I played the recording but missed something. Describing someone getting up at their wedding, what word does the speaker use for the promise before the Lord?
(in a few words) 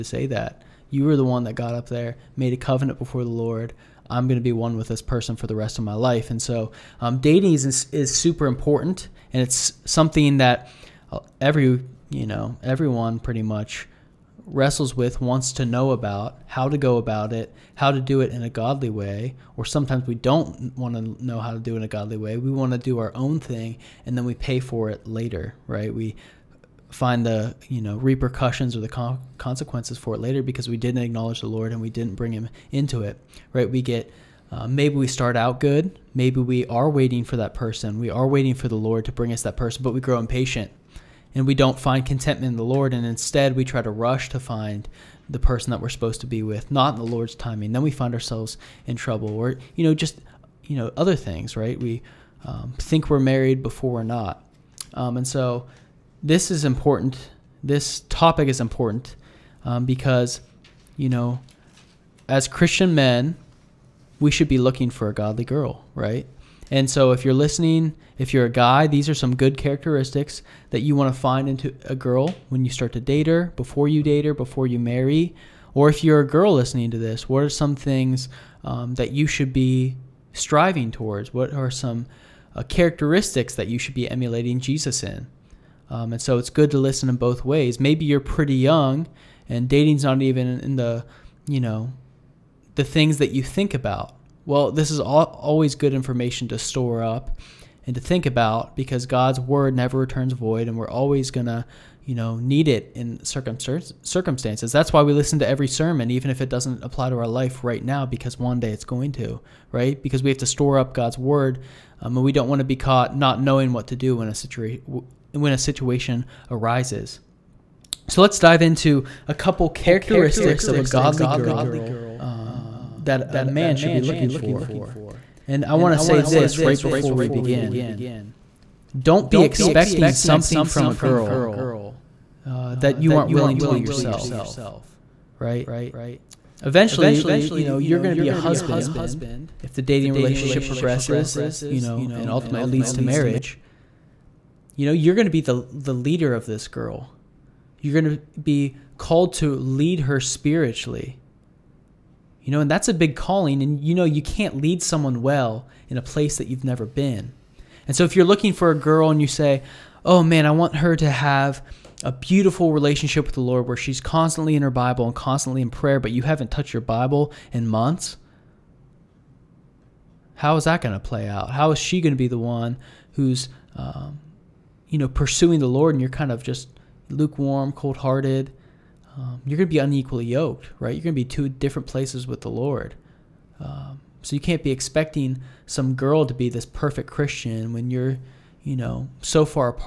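covenant.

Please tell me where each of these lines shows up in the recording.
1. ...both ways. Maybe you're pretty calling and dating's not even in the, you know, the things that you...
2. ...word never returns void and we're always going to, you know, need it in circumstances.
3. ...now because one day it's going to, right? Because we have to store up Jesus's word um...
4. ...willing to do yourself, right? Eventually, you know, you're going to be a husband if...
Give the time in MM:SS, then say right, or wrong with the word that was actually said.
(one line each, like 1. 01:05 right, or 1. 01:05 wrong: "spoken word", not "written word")
1. 01:27 wrong: "young", not "calling"
2. 01:39 right
3. 01:47 wrong: "God", not "Jesus"
4. 02:13 right.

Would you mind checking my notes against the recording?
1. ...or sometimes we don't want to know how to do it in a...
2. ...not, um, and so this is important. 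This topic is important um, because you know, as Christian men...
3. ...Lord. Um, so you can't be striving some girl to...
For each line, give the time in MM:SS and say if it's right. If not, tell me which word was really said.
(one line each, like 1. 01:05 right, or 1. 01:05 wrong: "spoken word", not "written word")
1. 00:19 right
2. 00:54 right
3. 03:02 wrong: "expecting", not "striving".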